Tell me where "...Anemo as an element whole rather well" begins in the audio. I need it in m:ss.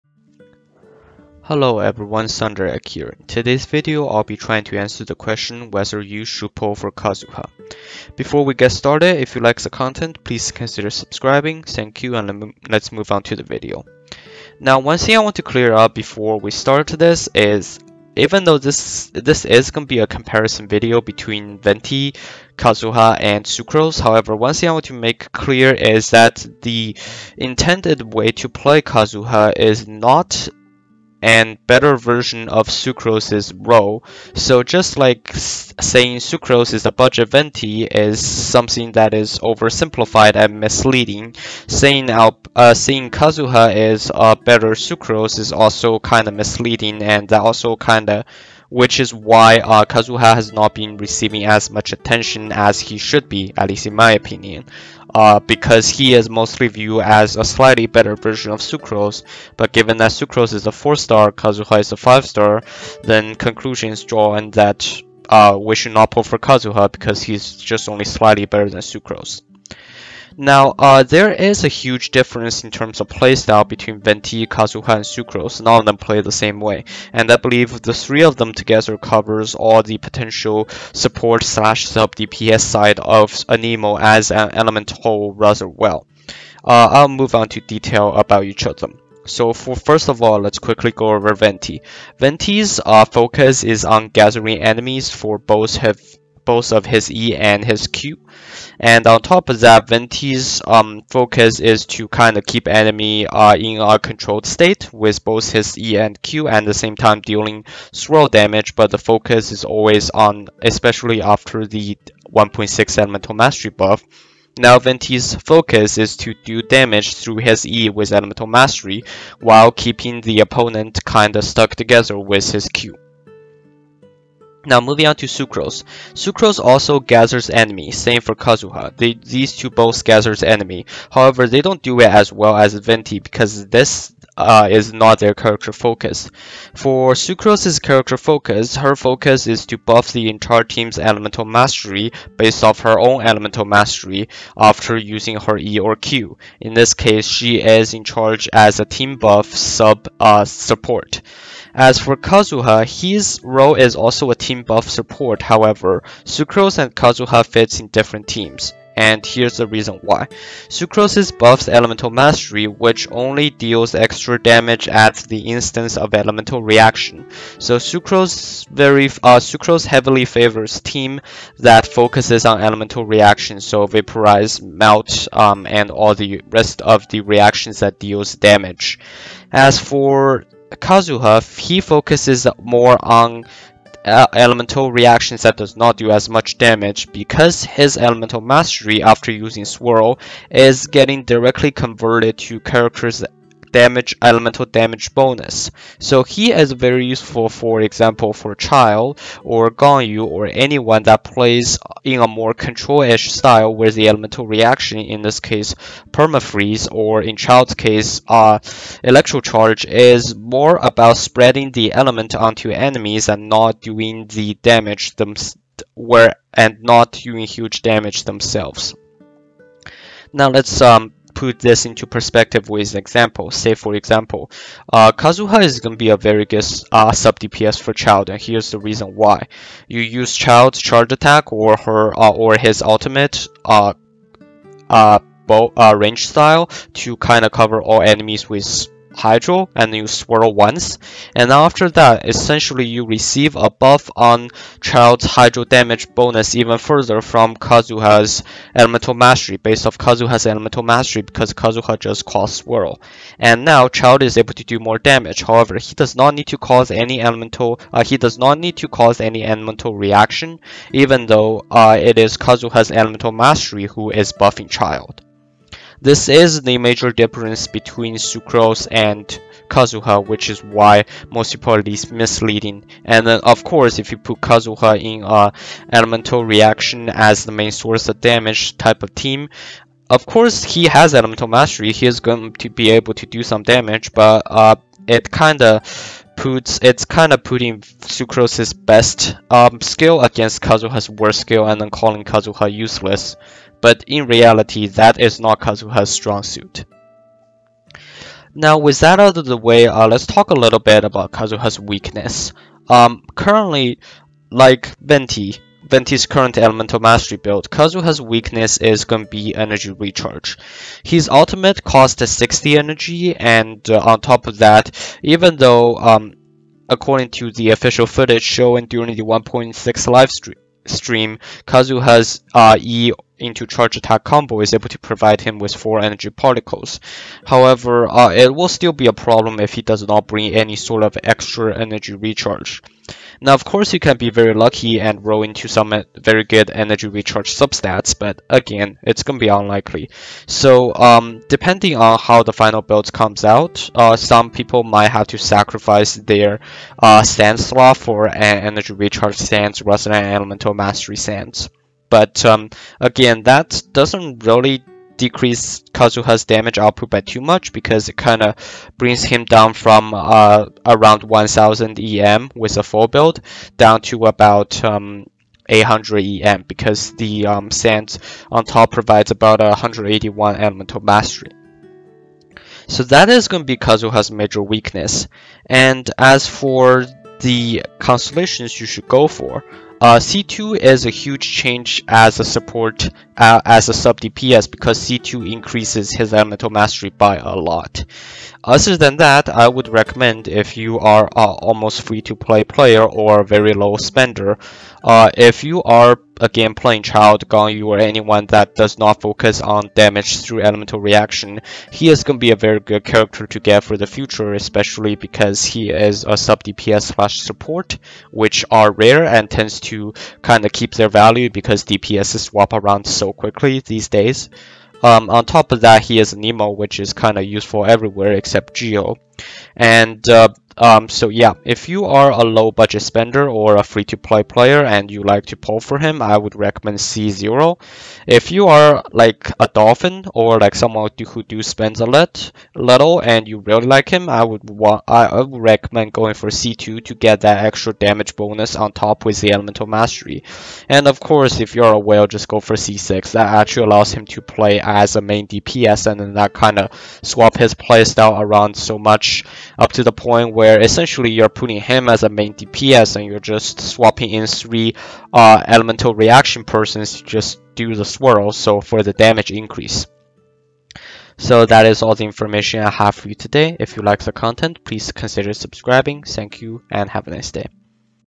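1:23.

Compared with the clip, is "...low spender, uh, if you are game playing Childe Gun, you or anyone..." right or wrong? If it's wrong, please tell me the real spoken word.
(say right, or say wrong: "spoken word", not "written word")
right.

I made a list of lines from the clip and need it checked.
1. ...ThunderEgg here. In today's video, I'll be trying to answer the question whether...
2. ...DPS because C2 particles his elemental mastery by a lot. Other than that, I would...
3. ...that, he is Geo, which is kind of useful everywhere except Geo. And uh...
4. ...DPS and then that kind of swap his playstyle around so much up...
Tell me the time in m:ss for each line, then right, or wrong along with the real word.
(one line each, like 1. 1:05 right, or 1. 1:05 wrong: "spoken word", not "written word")
1. 0:02 right
2. 6:24 wrong: "increases", not "particles"
3. 6:55 wrong: "Anemo", not "Geo"
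4. 7:25 right.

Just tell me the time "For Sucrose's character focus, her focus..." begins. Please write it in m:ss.
2:16.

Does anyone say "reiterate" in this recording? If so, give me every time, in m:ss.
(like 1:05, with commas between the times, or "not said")
not said.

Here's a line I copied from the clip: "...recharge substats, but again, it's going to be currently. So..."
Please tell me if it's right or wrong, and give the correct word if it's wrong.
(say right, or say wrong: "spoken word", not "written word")
wrong: "unlikely", not "currently".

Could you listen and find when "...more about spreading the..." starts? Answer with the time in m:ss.
3:30.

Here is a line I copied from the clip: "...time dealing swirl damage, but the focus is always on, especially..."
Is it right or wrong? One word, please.
right.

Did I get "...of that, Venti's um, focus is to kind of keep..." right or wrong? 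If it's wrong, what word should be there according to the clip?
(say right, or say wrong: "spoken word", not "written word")
right.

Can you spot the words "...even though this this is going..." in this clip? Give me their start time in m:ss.
0:18.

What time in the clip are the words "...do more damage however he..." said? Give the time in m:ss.
4:14.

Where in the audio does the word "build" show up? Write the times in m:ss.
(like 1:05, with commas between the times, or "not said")
5:07, 5:42, 6:03.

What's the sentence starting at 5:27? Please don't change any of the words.
However, uh, it will still be a problem if he does not bring any sort of extra energy recharge.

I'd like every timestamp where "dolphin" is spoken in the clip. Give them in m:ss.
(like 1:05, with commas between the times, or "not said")
7:09.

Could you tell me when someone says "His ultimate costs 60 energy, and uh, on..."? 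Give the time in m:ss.
5:11.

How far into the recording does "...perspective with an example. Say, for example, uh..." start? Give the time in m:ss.
3:42.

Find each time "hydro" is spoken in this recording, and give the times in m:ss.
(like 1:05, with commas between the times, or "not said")
3:59, 4:05.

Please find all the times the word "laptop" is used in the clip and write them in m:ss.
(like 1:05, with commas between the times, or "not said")
not said.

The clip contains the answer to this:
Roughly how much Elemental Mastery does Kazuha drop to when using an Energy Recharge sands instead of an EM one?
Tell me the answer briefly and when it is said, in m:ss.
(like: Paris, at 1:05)
800, at 6:05.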